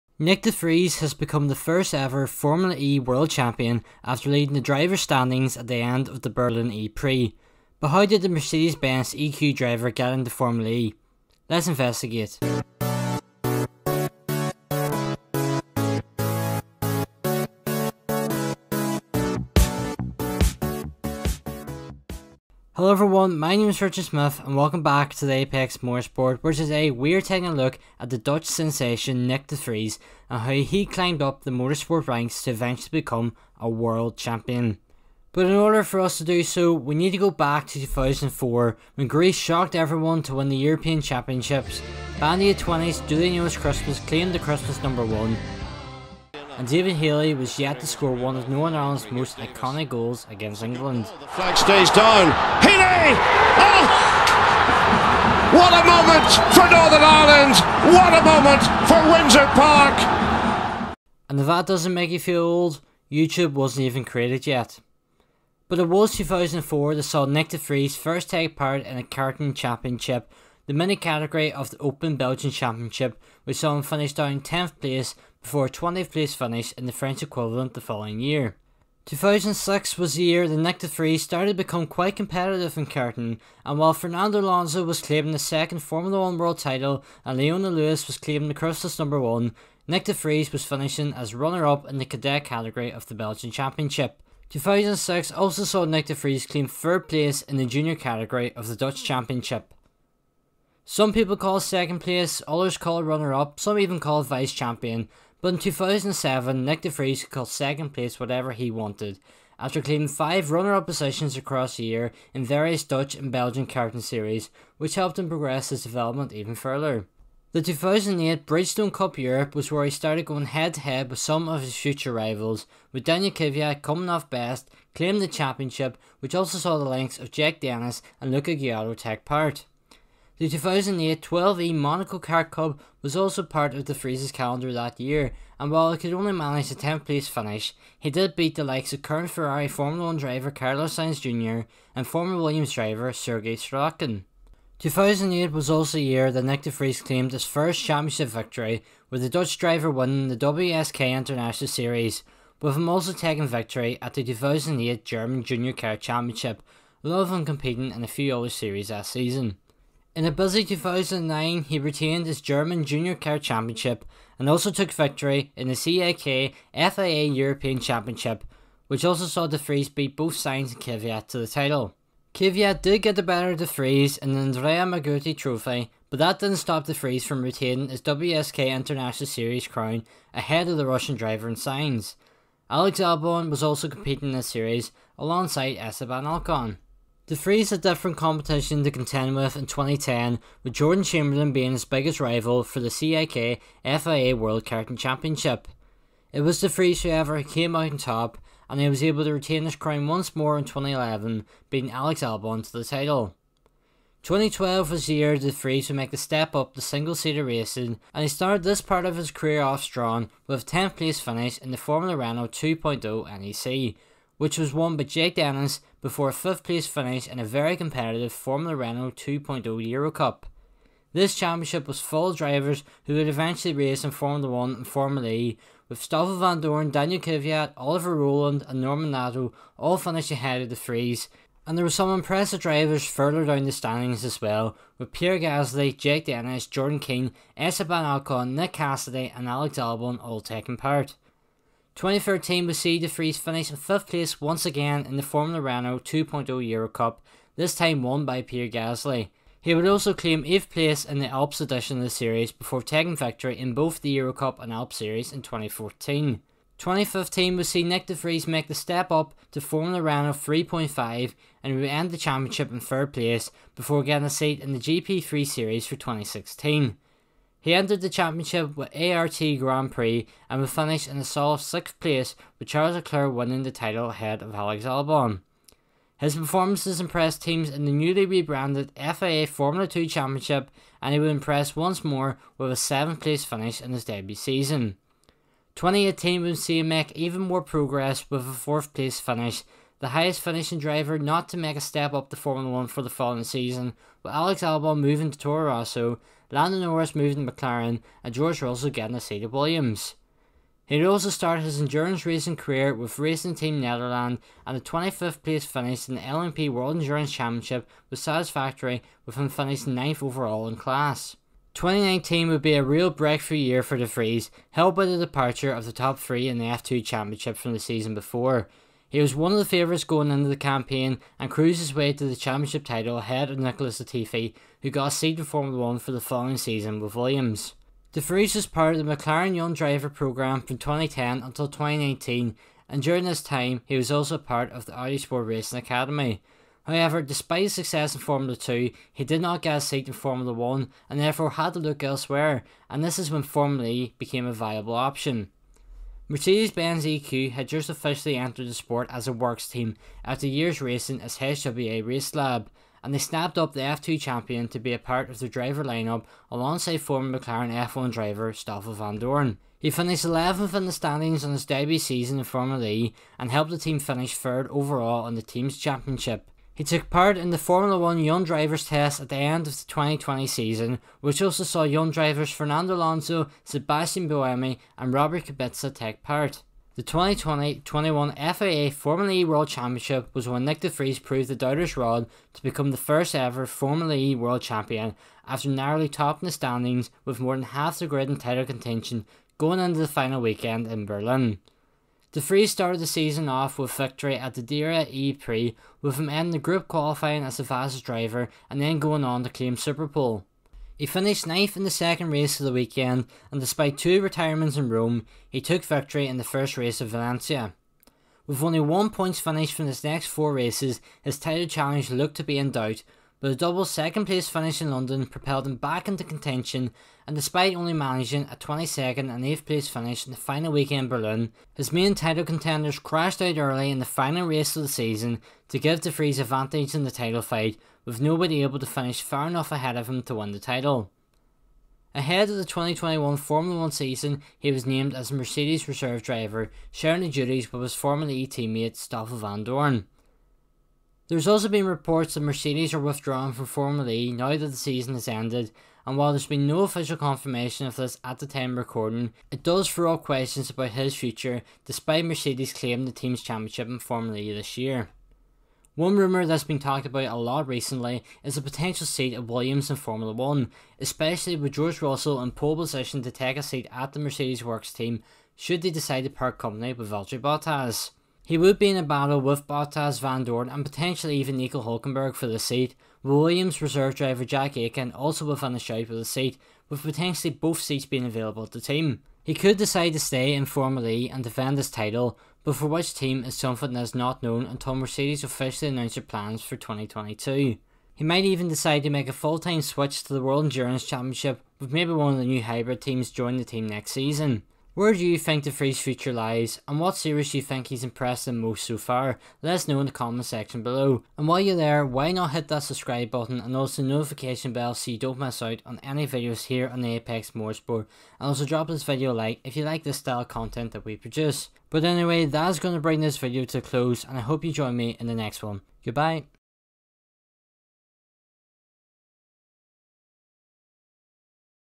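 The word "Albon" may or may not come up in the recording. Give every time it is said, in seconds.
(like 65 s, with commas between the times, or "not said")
182 s, 202 s, 239 s, 274 s, 294 s.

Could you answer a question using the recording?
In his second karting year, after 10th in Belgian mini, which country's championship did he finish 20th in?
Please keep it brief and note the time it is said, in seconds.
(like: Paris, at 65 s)
French, at 76 s.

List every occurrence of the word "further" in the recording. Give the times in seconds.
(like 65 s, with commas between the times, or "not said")
116 s, 233 s.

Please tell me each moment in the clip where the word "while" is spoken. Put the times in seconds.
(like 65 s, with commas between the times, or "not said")
83 s, 135 s, 446 s, 501 s.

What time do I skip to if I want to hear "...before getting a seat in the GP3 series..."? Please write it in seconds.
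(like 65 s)
263 s.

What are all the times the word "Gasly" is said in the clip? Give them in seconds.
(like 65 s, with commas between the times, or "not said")
235 s, 248 s.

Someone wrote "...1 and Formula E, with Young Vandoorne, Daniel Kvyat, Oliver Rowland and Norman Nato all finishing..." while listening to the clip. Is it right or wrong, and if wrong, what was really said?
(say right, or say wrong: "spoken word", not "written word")
wrong: "Stoffel", not "Young".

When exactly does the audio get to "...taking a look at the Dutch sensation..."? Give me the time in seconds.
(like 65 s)
27 s.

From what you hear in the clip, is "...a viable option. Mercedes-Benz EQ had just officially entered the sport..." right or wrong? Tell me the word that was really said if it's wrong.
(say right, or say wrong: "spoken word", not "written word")
right.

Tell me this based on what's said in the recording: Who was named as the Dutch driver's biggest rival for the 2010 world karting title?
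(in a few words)
Jordan Chamberlain.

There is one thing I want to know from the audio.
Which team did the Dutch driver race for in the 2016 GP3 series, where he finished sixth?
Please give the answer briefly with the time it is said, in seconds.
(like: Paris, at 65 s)
ART Grand Prix, at 268 s.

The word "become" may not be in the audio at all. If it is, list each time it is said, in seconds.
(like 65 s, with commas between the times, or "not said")
1 s, 32 s, 81 s, 382 s.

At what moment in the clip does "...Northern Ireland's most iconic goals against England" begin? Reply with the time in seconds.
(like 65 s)
48 s.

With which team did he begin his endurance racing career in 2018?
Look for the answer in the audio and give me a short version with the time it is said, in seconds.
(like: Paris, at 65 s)
Racing Team Netherlands, at 303 s.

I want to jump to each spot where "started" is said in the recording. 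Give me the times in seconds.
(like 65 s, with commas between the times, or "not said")
81 s, 119 s, 208 s, 301 s, 392 s.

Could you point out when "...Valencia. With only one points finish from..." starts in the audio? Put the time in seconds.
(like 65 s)
407 s.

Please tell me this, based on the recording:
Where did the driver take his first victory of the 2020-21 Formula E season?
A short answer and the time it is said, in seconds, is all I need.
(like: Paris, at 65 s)
Diriyah, at 394 s.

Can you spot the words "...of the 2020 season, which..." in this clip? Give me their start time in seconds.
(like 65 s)
369 s.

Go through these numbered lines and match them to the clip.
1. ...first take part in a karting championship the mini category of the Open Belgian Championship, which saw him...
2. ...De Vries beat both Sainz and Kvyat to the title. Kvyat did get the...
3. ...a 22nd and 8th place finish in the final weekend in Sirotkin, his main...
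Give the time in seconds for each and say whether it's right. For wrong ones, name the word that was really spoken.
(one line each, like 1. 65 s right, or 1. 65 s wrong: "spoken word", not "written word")
1. 67 s right
2. 169 s right
3. 418 s wrong: "Berlin", not "Sirotkin".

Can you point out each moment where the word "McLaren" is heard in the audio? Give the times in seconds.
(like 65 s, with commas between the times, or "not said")
297 s, 329 s, 357 s.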